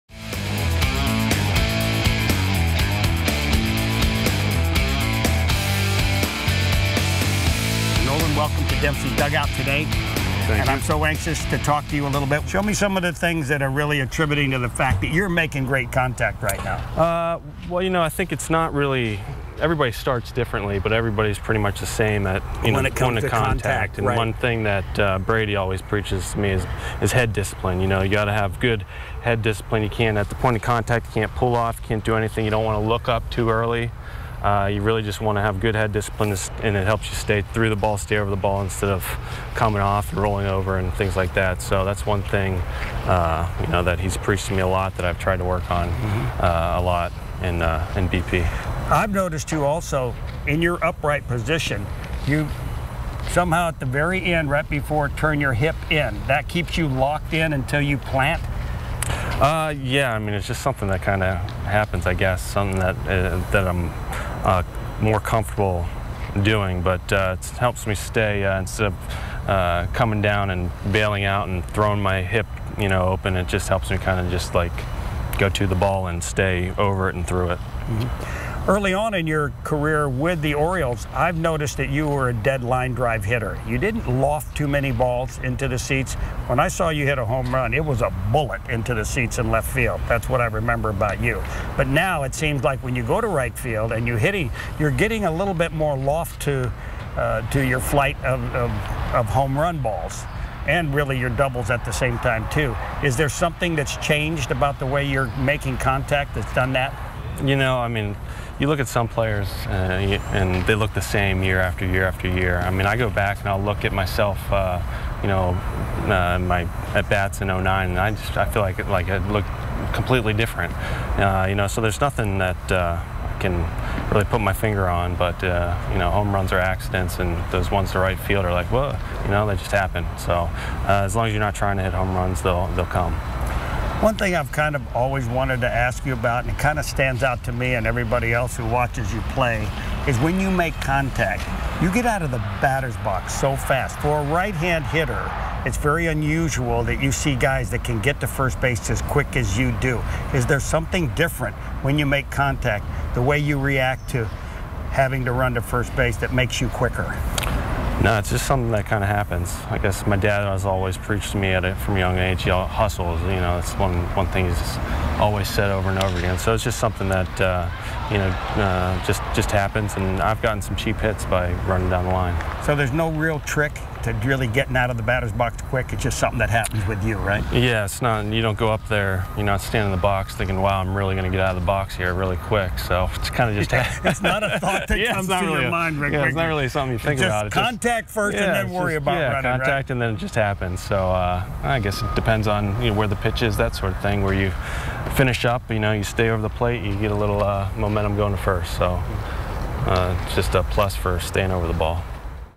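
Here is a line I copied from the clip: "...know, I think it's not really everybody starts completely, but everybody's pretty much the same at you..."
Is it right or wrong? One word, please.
wrong.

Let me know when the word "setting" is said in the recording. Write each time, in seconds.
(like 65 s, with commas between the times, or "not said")
not said.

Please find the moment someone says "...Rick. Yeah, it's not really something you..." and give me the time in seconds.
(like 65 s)
185 s.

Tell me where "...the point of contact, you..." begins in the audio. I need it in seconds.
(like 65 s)
30 s.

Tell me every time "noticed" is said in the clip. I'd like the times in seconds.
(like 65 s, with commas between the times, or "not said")
49 s, 81 s.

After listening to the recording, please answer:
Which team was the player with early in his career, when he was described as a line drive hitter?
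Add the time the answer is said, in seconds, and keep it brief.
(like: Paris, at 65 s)
Orioles, at 80 s.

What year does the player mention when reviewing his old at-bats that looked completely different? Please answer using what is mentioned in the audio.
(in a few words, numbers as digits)
2009.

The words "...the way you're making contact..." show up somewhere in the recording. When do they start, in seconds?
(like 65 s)
104 s.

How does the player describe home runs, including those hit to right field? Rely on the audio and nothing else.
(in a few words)
Accidents.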